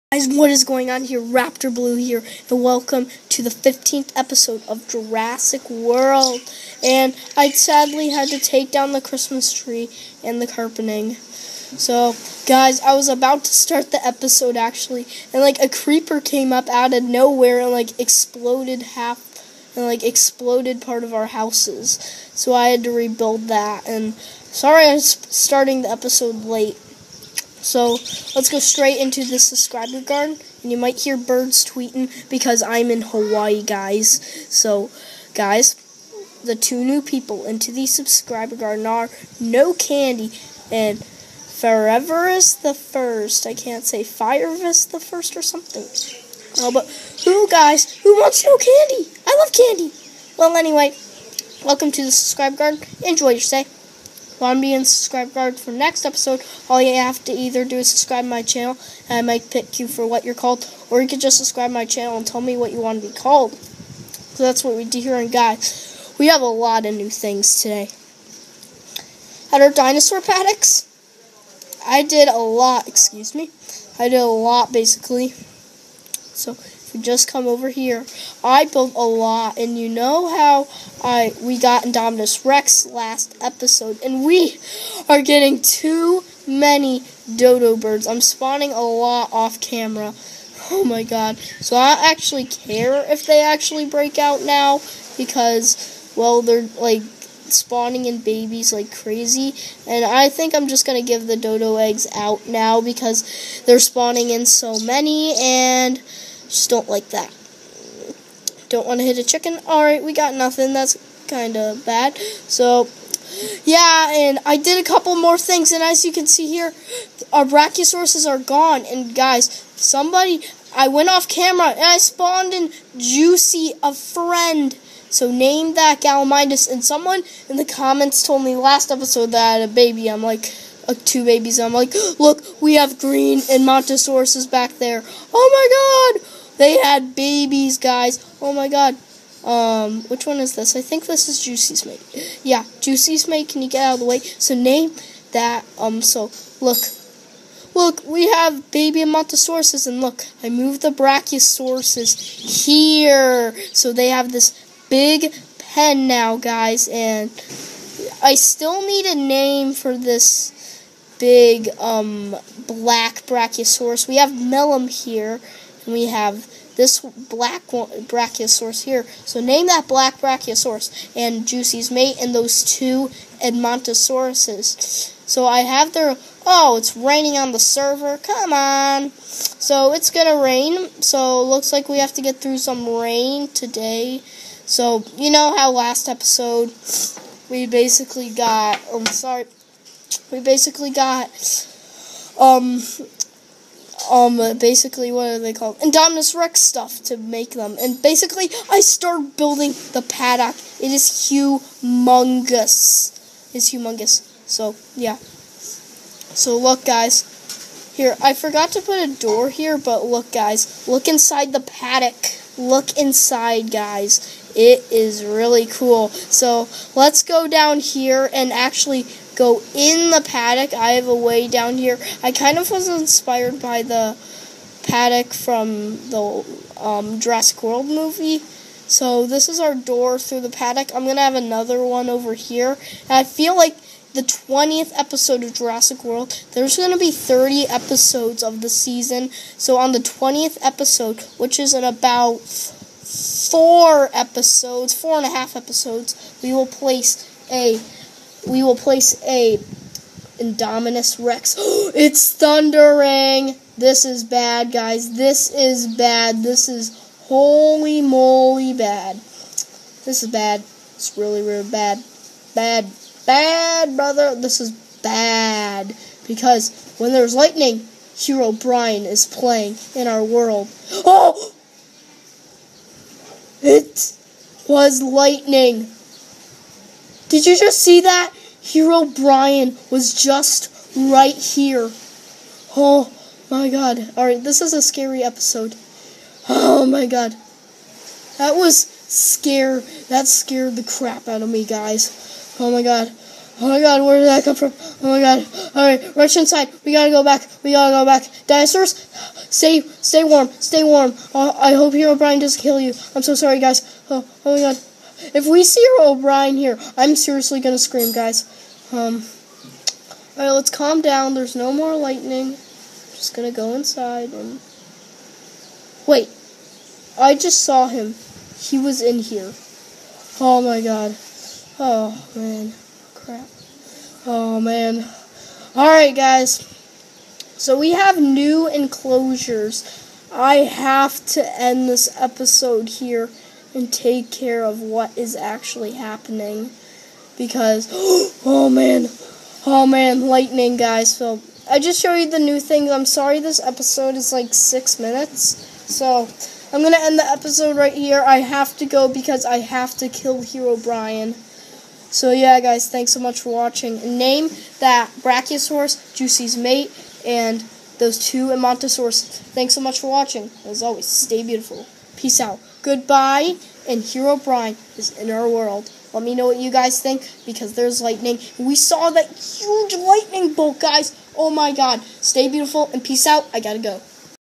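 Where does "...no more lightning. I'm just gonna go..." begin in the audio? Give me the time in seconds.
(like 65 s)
311 s.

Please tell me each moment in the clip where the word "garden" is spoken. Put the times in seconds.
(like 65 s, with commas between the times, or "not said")
30 s, 38 s, 52 s.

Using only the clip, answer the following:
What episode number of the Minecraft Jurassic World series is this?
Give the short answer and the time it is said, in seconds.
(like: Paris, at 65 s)
15th, at 3 s.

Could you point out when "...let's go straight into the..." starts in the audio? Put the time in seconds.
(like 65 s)
28 s.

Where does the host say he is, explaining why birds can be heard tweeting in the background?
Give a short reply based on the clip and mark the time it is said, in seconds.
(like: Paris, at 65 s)
Hawaii, at 33 s.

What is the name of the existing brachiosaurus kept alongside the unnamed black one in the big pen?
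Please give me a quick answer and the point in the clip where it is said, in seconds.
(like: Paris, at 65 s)
Melum, at 164 s.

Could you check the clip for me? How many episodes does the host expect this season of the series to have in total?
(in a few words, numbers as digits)
30.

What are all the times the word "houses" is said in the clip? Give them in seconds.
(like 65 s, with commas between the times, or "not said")
21 s.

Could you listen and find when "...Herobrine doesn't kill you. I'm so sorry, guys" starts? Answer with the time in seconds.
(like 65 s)
301 s.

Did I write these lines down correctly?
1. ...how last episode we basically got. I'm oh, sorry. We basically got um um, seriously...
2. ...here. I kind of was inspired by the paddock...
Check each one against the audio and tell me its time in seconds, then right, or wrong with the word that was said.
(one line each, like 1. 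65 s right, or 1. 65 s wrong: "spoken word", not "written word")
1. 185 s wrong: "basically", not "seriously"
2. 221 s right.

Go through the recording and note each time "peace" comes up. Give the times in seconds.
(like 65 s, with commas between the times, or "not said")
362 s, 373 s.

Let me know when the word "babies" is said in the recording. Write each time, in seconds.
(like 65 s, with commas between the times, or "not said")
98 s, 131 s, 137 s.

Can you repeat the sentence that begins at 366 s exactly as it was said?
Let me know what you guys think because there's lightning.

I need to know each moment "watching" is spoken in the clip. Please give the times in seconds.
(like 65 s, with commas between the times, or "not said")
353 s, 360 s.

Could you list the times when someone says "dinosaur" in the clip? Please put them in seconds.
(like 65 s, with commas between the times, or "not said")
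69 s, 298 s.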